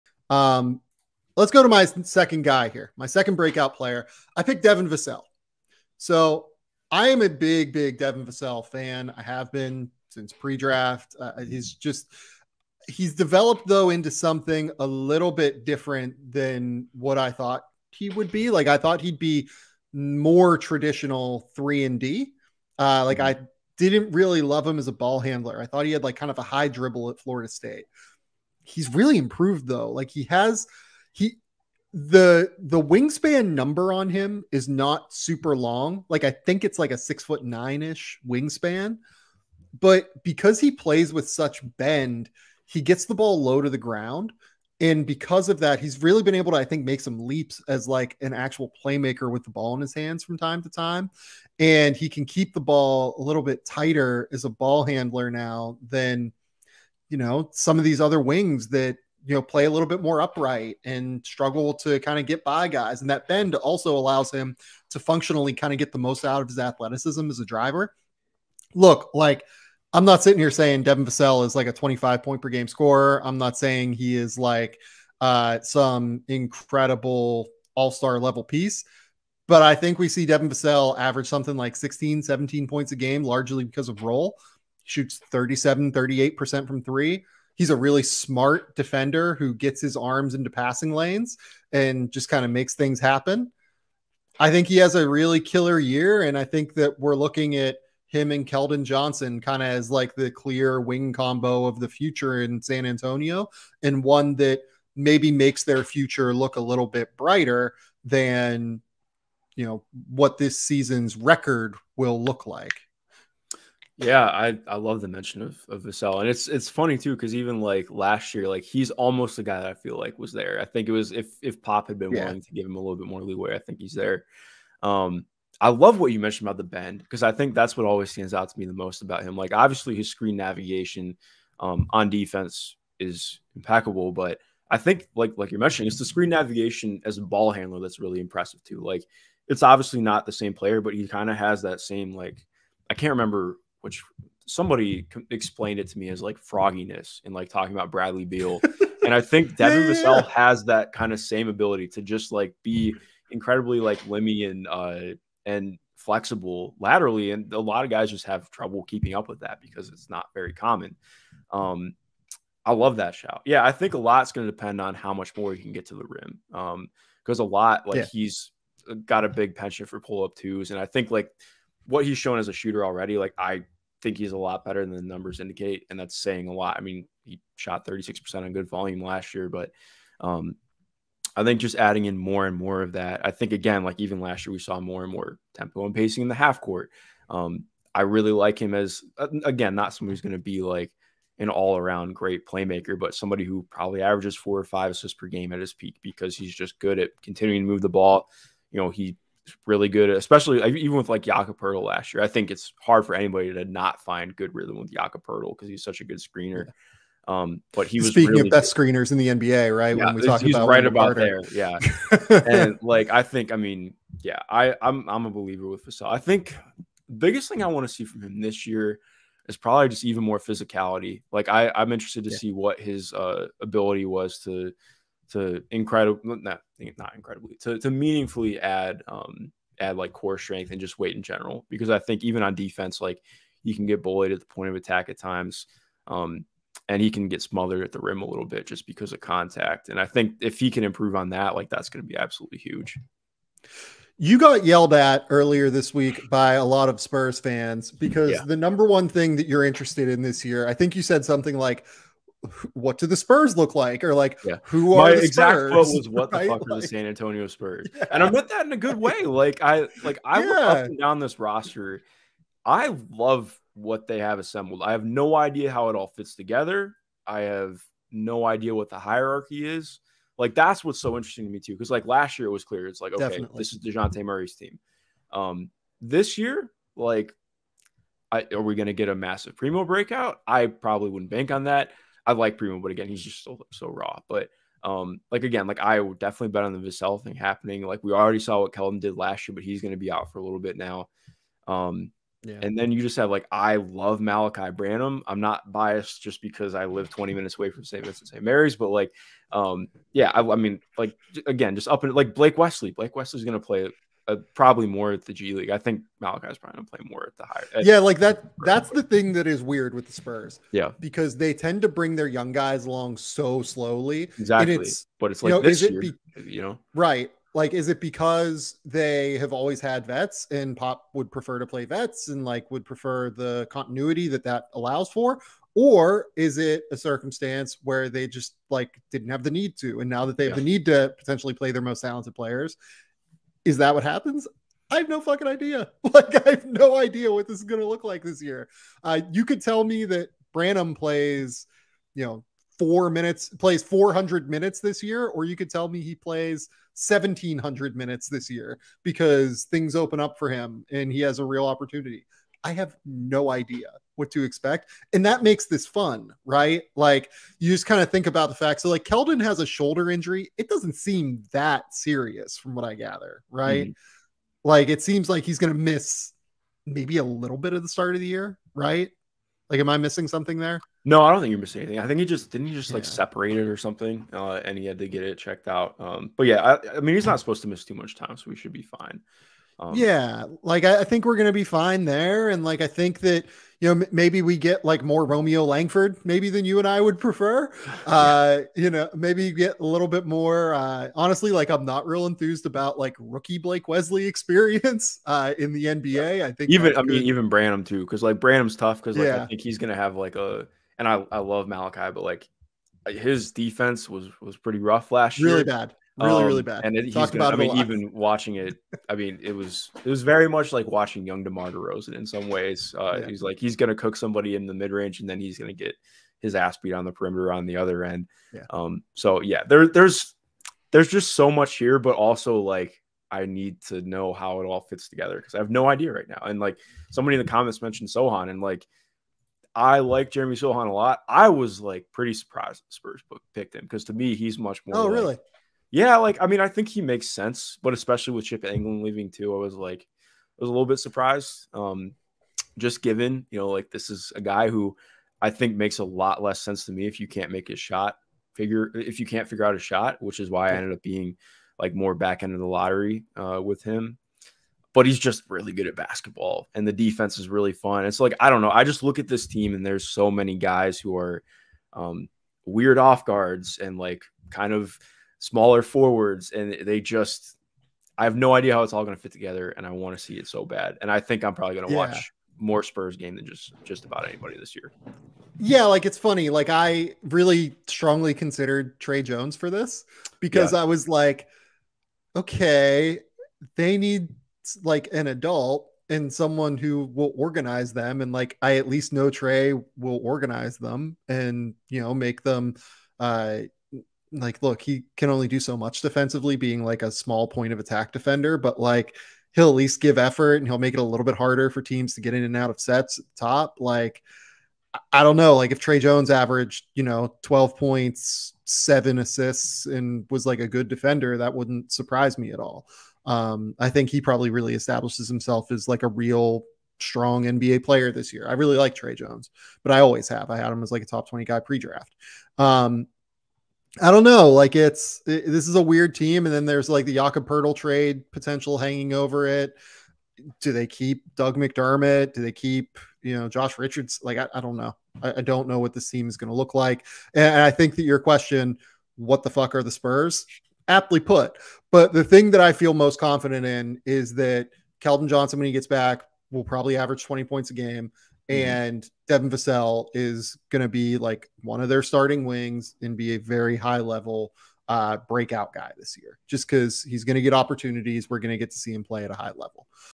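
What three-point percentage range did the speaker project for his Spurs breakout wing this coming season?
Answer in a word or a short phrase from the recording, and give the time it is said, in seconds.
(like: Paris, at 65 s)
37, 38%, at 85 s.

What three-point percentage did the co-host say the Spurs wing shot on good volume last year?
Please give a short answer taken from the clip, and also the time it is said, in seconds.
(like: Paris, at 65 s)
36%, at 177 s.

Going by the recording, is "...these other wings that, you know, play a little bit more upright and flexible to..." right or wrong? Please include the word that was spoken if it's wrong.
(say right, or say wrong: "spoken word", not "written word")
wrong: "struggle", not "flexible".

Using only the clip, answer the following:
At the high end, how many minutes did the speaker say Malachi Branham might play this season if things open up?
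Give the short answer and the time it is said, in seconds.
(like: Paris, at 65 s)
1,700, at 347 s.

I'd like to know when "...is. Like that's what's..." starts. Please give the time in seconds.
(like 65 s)
269 s.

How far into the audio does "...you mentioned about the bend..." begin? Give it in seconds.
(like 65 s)
126 s.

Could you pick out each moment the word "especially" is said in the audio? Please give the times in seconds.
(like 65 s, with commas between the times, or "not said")
200 s, 437 s.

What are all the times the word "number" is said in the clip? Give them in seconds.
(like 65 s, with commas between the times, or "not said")
33 s, 175 s, 248 s.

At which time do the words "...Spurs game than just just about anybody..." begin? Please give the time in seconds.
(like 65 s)
472 s.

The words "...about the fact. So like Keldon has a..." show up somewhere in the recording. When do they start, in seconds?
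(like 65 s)
358 s.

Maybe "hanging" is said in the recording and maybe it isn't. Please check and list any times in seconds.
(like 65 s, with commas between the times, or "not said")
528 s.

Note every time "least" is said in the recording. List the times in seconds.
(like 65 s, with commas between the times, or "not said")
488 s, 499 s.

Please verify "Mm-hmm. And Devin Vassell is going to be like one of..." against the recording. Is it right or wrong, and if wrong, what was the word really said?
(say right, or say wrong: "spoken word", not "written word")
right.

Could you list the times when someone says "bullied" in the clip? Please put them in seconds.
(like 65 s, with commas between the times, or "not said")
234 s.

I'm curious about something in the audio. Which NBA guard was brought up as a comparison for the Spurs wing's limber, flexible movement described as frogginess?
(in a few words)
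Bradley Beal.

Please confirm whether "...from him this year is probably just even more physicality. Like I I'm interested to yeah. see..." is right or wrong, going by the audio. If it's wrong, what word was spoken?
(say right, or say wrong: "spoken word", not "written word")
right.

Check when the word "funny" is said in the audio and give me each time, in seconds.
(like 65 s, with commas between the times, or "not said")
116 s, 476 s.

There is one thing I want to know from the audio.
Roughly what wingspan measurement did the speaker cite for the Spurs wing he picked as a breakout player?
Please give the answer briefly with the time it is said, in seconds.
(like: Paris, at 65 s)
6 foot 9, at 36 s.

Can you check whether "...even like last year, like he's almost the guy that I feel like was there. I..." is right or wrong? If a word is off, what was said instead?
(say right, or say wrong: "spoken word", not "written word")
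right.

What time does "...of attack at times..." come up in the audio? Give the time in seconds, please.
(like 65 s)
234 s.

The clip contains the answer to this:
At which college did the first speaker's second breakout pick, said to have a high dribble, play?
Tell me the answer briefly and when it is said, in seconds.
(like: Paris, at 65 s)
Florida State, at 27 s.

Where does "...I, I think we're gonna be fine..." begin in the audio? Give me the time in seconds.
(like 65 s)
380 s.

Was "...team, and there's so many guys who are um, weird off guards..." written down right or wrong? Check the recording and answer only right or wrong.
right.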